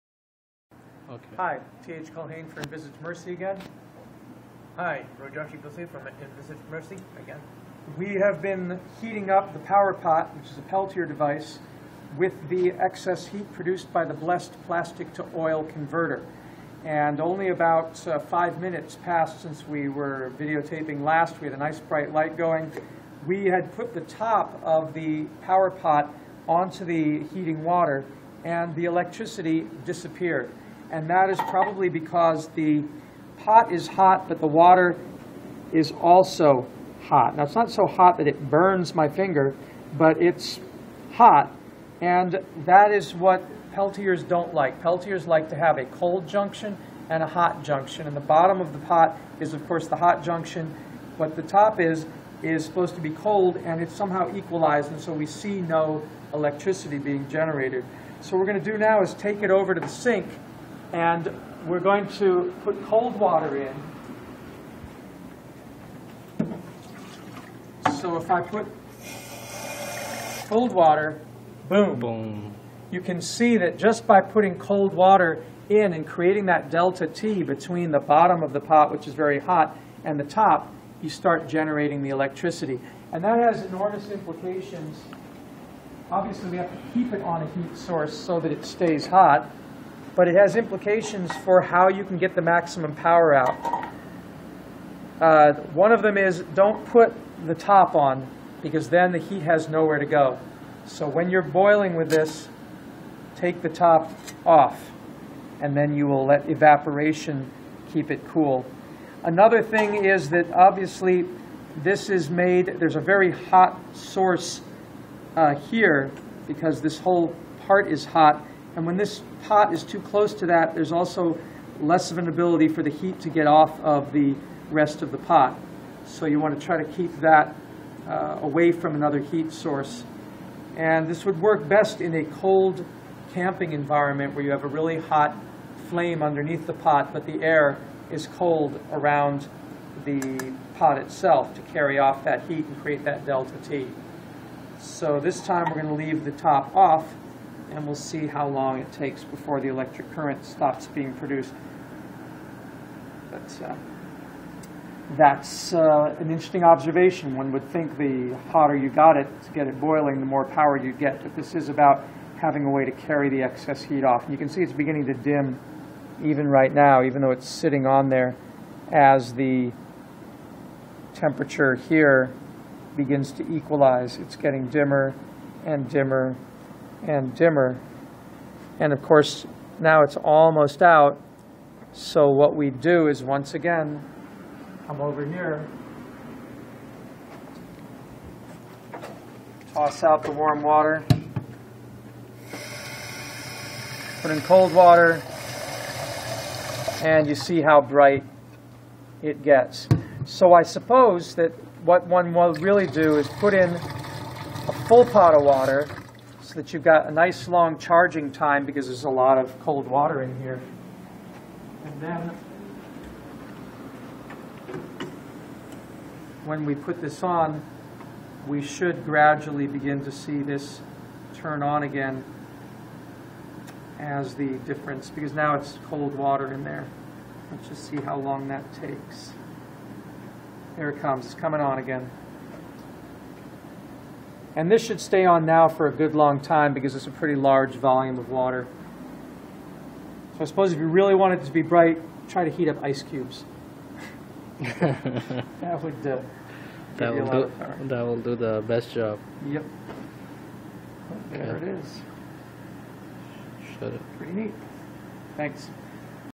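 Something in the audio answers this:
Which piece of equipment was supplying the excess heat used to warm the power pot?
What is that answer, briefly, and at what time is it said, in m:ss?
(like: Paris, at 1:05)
plastic to oil converter, at 0:14.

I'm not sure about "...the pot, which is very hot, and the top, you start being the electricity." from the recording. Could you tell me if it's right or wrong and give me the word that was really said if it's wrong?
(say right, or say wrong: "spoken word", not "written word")
wrong: "generating", not "being".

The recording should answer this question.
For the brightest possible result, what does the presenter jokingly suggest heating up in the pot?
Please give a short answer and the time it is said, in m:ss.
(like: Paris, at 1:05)
ice cubes, at 4:02.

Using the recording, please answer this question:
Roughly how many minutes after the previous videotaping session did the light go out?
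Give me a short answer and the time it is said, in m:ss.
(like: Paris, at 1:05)
5, at 0:18.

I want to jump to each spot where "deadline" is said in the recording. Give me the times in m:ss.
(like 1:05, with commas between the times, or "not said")
not said.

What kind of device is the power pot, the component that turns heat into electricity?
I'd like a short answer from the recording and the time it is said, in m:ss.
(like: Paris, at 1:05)
Peltier device, at 0:10.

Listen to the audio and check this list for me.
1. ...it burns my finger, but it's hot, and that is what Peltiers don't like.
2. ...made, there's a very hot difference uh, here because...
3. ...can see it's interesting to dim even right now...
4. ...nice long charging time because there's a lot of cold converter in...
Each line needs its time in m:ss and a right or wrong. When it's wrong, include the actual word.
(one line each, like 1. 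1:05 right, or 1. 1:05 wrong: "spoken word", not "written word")
1. 0:38 right
2. 1:52 wrong: "source", not "difference"
3. 2:44 wrong: "beginning", not "interesting"
4. 3:27 wrong: "water", not "converter".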